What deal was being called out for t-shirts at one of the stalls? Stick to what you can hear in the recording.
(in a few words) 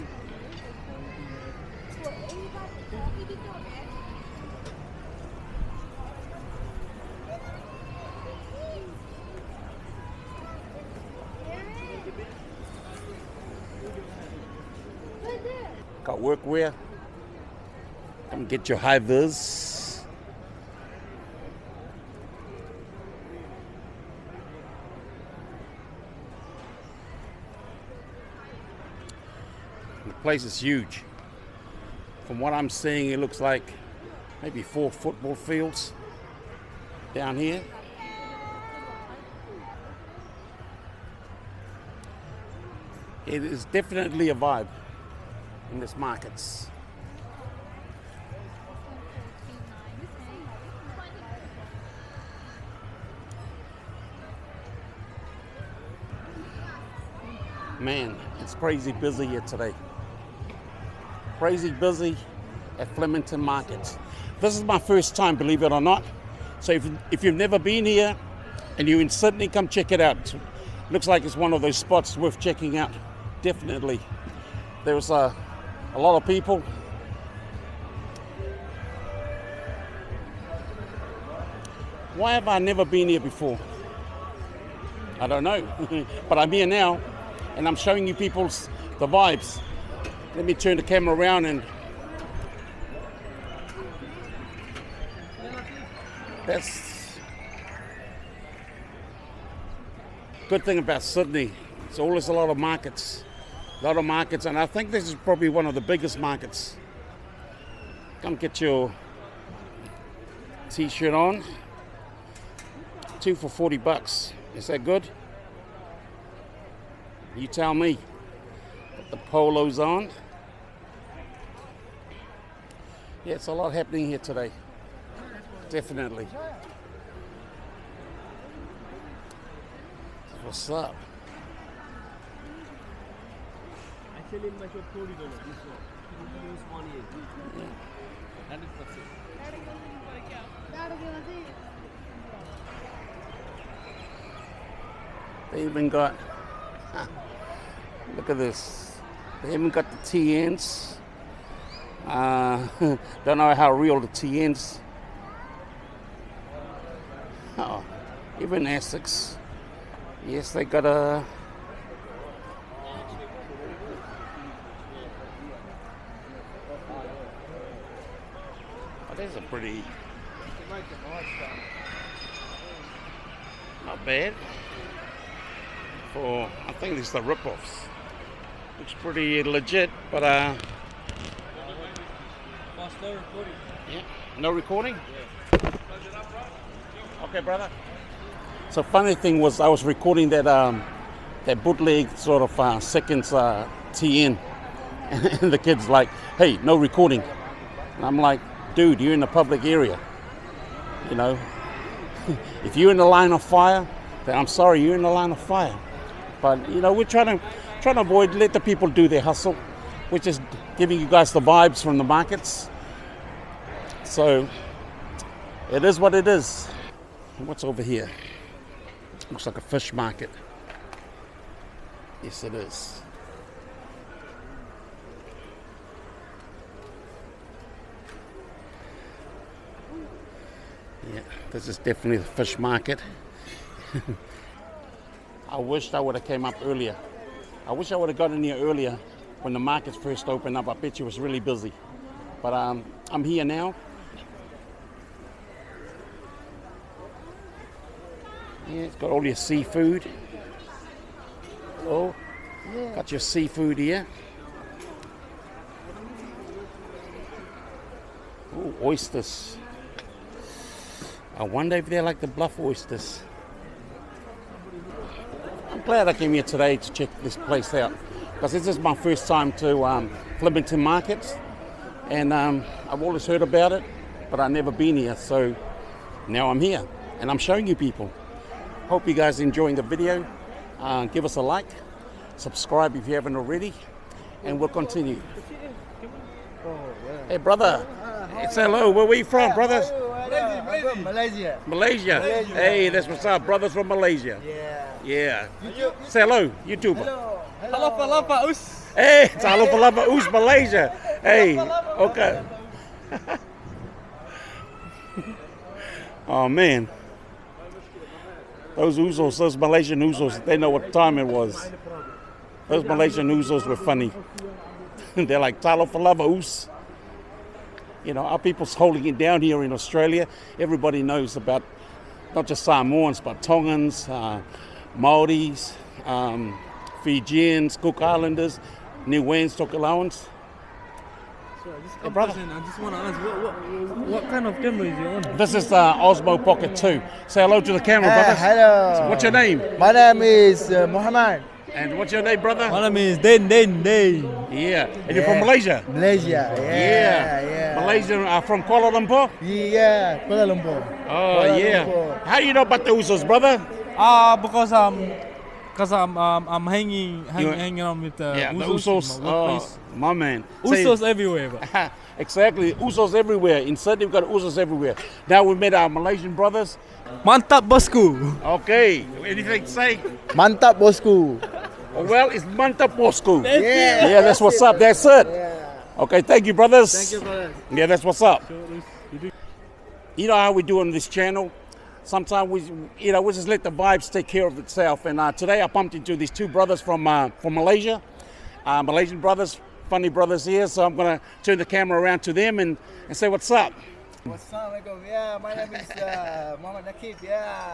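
Two for 40 bucks.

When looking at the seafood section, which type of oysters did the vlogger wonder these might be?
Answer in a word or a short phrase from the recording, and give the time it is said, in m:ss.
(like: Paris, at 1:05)
Bluff oysters, at 4:22.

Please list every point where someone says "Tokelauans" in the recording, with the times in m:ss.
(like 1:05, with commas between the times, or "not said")
5:29.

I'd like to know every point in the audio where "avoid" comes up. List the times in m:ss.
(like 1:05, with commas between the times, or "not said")
3:28.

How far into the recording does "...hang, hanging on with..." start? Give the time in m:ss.
5:57.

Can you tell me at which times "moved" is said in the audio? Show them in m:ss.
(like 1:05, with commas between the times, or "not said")
not said.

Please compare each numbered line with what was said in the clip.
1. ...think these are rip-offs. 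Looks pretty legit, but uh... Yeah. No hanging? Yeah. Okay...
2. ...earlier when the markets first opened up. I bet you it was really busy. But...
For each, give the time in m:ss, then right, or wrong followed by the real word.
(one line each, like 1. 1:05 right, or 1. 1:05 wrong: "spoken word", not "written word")
1. 2:56 wrong: "recording", not "hanging"
2. 3:58 right.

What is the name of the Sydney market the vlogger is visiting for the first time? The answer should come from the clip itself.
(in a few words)
Flemington Market.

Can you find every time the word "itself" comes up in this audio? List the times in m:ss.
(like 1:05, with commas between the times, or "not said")
6:24.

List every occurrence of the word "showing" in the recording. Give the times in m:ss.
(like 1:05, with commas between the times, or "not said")
1:27, 4:37.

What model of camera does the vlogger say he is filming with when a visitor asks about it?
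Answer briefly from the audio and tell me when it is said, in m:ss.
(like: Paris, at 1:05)
Osmo Pocket 2, at 5:35.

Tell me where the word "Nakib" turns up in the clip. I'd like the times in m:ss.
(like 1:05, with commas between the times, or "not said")
6:36.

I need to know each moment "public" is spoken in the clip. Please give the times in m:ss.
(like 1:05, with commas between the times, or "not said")
3:19.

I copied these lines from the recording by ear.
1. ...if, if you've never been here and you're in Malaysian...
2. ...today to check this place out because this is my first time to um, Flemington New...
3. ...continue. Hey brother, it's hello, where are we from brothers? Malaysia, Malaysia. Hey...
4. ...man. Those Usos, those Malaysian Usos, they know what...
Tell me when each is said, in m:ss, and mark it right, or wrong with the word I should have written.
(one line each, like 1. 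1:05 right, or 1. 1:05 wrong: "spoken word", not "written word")
1. 1:06 wrong: "Sydney", not "Malaysian"
2. 4:26 wrong: "Markets", not "New"
3. 4:44 right
4. 5:06 right.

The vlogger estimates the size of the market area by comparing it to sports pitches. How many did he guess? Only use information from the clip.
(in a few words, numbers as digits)
4 football fields.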